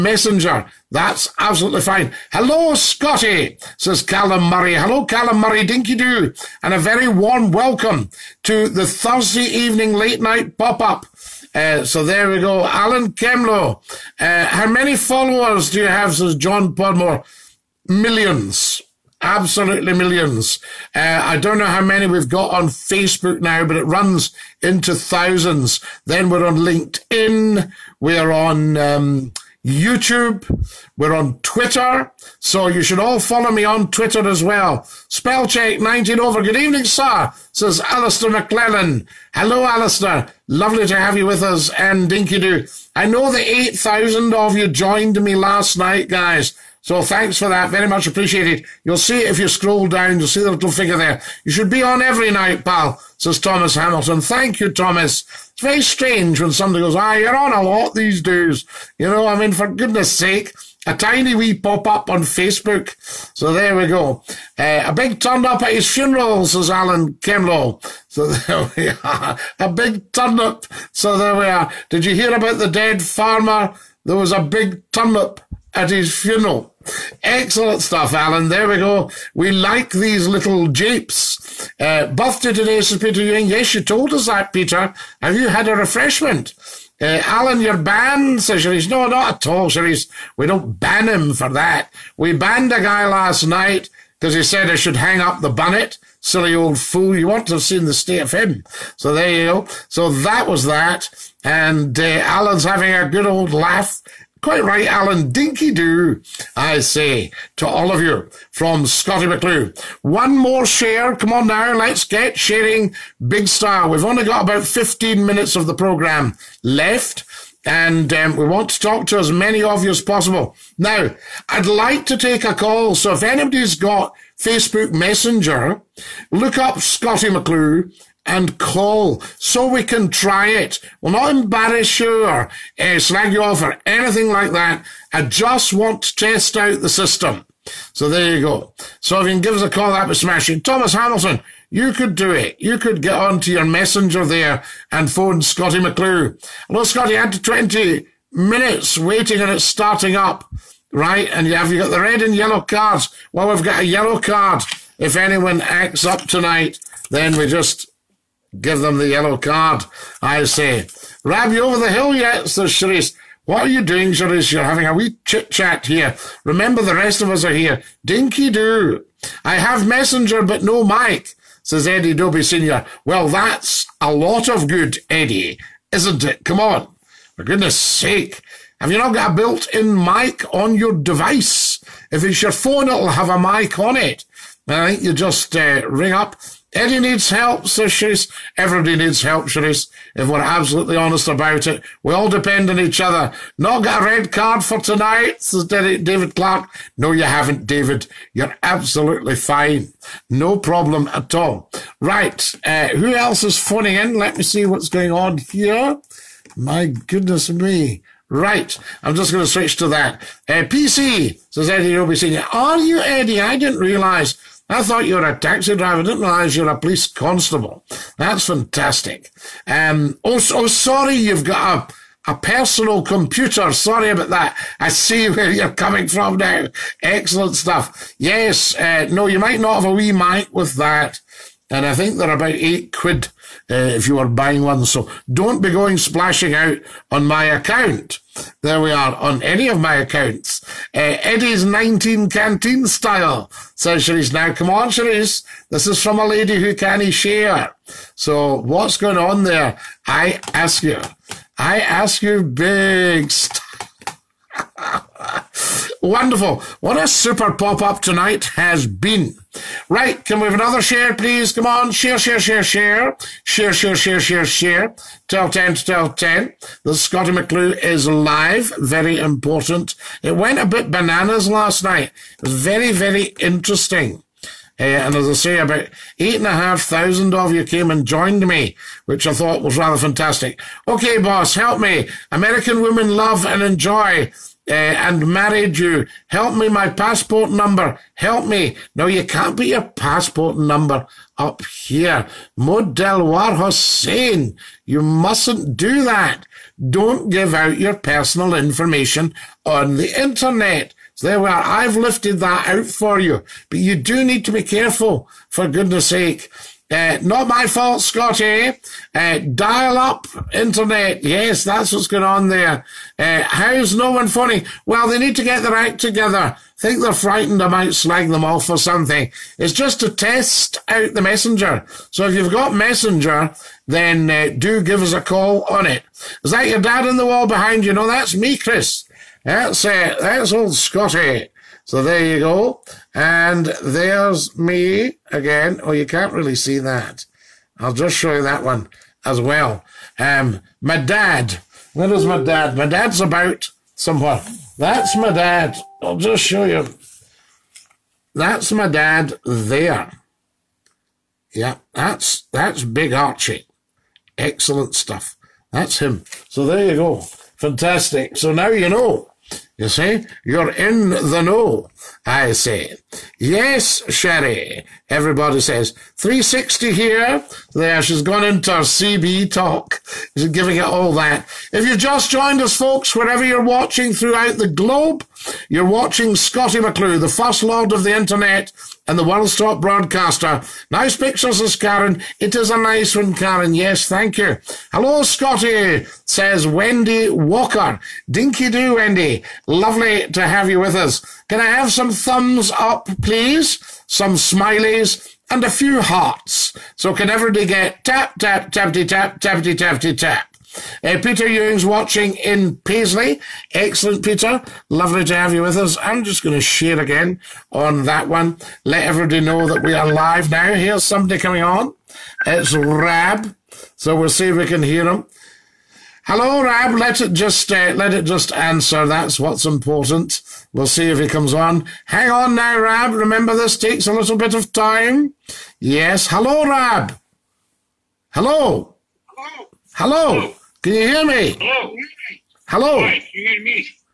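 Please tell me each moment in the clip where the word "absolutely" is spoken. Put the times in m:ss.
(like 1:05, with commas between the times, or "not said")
0:01, 0:19, 3:10, 3:18.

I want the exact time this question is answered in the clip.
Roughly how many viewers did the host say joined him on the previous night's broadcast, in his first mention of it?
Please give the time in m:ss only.
0:43.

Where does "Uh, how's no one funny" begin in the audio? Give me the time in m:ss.
5:13.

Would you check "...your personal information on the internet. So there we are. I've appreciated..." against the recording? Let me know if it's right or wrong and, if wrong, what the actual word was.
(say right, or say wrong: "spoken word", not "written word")
wrong: "lifted", not "appreciated".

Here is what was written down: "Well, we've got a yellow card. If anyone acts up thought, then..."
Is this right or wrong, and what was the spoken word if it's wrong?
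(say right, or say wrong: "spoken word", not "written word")
wrong: "tonight", not "thought".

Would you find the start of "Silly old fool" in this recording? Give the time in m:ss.
1:36.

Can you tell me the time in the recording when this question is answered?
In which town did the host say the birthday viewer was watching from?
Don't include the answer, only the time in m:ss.
6:42.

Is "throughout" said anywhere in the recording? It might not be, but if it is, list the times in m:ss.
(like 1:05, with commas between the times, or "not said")
6:14.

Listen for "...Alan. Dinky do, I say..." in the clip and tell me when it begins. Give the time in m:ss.
1:44.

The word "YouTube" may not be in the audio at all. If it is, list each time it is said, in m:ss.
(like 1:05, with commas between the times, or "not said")
0:29.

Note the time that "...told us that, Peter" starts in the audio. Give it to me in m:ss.
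1:23.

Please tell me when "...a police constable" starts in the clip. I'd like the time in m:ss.
3:36.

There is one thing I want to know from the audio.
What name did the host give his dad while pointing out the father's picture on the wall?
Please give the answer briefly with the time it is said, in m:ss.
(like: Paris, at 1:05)
Big Archie, at 5:52.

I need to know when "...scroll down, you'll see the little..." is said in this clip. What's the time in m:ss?
0:49.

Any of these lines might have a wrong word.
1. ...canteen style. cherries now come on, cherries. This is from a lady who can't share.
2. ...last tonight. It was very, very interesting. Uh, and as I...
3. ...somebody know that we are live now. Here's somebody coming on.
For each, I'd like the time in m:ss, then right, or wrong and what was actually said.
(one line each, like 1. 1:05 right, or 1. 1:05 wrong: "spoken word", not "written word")
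1. 4:02 right
2. 4:31 wrong: "night", not "tonight"
3. 6:49 wrong: "everybody", not "somebody".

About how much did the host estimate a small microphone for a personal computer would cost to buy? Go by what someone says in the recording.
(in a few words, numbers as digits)
8 quid.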